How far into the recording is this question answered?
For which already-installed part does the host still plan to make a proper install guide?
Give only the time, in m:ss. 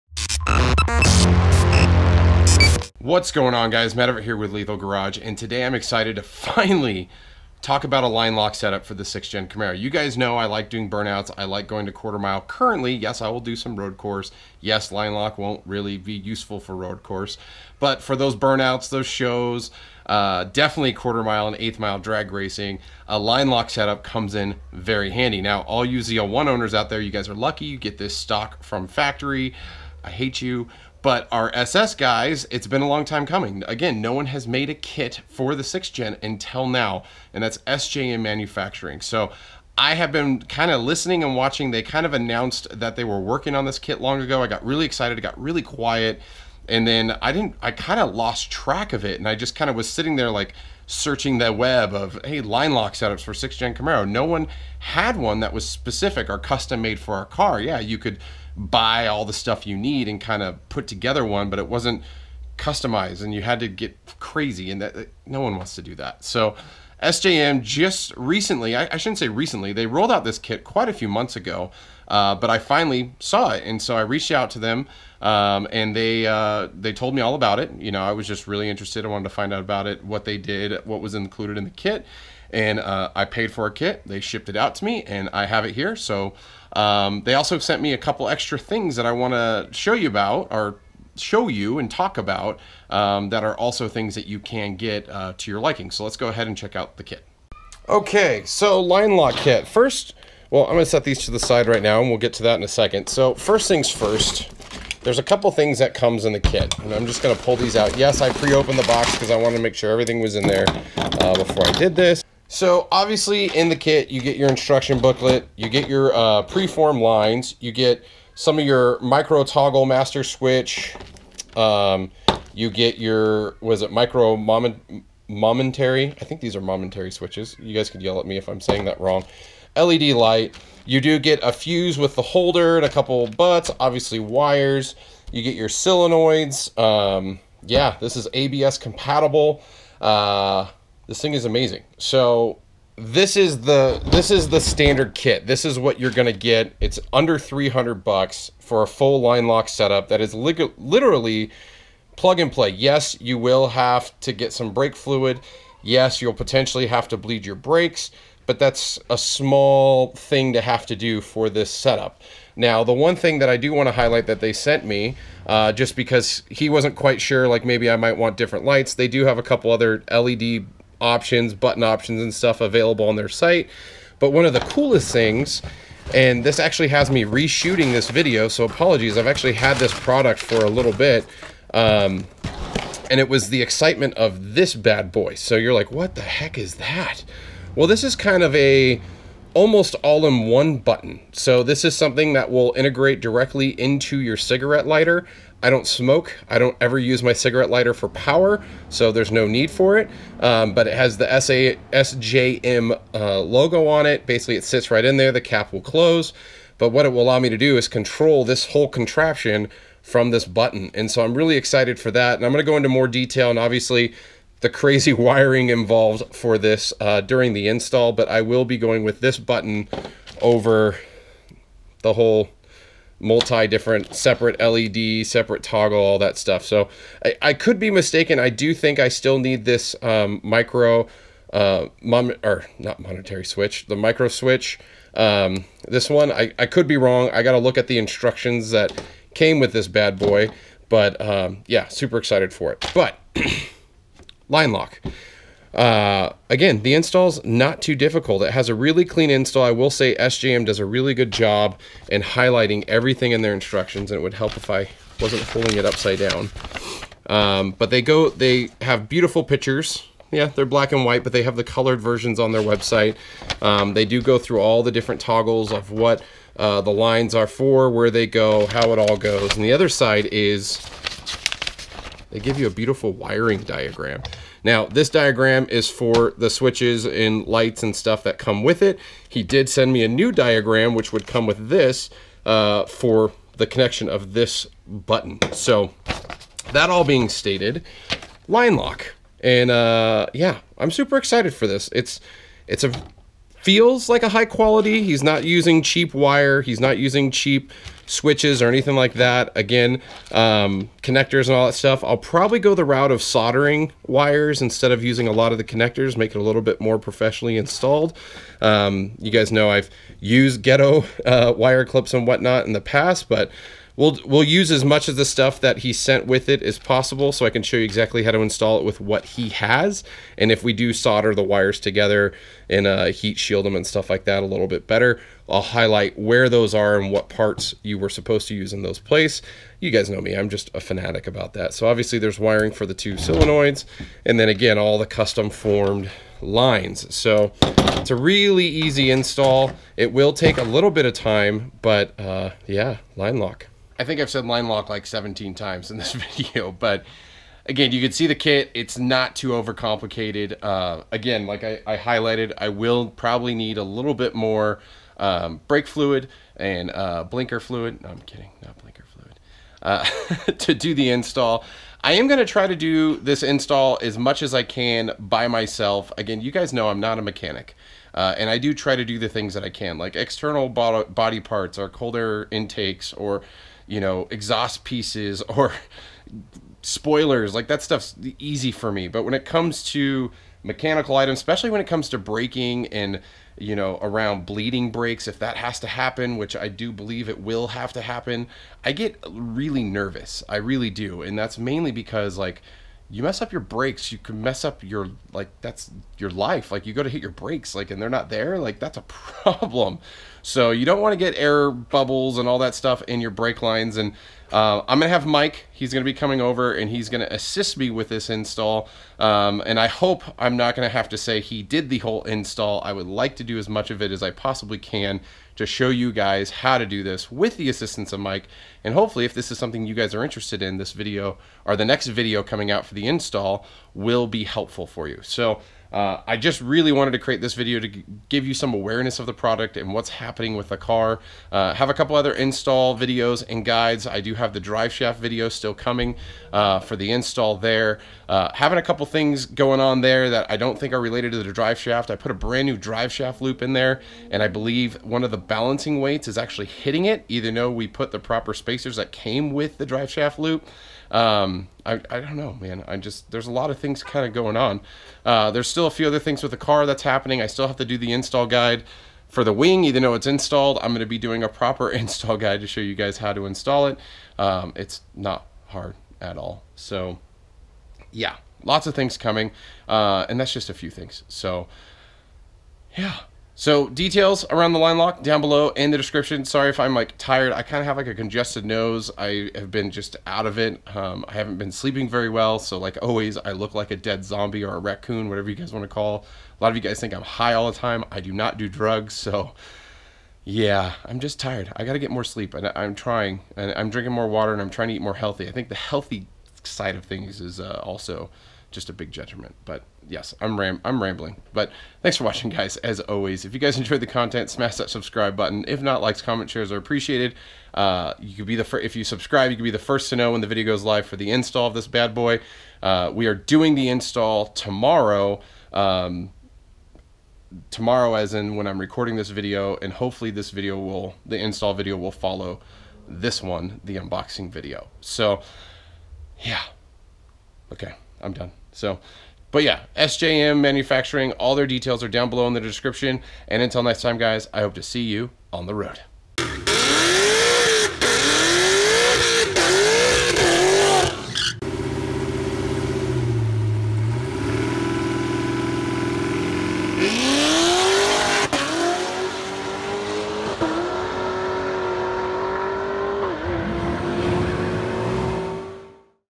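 7:39.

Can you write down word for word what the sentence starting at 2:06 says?
I think these are momentary switches.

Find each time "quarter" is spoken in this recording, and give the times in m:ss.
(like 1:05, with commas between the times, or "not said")
0:11, 0:20.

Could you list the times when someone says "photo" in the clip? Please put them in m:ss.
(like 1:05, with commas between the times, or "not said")
not said.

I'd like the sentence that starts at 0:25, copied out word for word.
Now, all you ZL1 owners out there, you guys are lucky.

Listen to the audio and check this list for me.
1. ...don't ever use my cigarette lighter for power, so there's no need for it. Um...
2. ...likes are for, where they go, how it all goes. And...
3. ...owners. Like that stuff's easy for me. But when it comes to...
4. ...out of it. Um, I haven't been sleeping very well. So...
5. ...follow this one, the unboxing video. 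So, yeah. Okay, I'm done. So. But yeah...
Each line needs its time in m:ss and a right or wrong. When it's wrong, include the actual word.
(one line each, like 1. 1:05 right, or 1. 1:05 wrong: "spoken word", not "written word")
1. 3:16 right
2. 4:26 wrong: "lines", not "likes"
3. 6:16 wrong: "spoilers", not "owners"
4. 8:00 right
5. 8:42 right.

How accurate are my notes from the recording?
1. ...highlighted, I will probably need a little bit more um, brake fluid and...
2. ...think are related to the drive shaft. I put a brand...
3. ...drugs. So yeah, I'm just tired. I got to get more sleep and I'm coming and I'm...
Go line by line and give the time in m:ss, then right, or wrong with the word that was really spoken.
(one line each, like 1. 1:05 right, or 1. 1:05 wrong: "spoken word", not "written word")
1. 5:51 right
2. 7:20 right
3. 8:08 wrong: "trying", not "coming".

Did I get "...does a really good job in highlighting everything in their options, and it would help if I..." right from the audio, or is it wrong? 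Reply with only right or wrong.
wrong.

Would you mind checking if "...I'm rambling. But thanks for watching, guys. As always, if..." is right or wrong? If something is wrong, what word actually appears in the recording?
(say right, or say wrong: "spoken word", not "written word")
right.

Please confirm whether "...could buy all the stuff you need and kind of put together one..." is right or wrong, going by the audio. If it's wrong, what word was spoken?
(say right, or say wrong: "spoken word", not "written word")
right.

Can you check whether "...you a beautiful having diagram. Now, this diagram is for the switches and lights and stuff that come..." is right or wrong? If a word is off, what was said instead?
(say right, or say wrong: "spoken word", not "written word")
wrong: "wiring", not "having".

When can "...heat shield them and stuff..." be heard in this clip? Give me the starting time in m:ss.
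5:23.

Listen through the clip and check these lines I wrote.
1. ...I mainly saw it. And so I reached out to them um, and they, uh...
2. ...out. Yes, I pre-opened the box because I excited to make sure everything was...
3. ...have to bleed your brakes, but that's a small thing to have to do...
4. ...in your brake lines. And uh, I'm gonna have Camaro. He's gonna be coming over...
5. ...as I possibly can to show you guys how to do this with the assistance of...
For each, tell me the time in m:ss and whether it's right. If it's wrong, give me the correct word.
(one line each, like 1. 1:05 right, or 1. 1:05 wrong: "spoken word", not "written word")
1. 1:12 wrong: "finally", not "mainly"
2. 1:47 wrong: "wanted", not "excited"
3. 2:36 right
4. 6:43 wrong: "Mike", not "Camaro"
5. 6:54 right.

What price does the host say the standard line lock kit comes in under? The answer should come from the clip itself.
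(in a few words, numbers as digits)
300 bucks.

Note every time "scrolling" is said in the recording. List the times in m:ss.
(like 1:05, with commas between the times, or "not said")
not said.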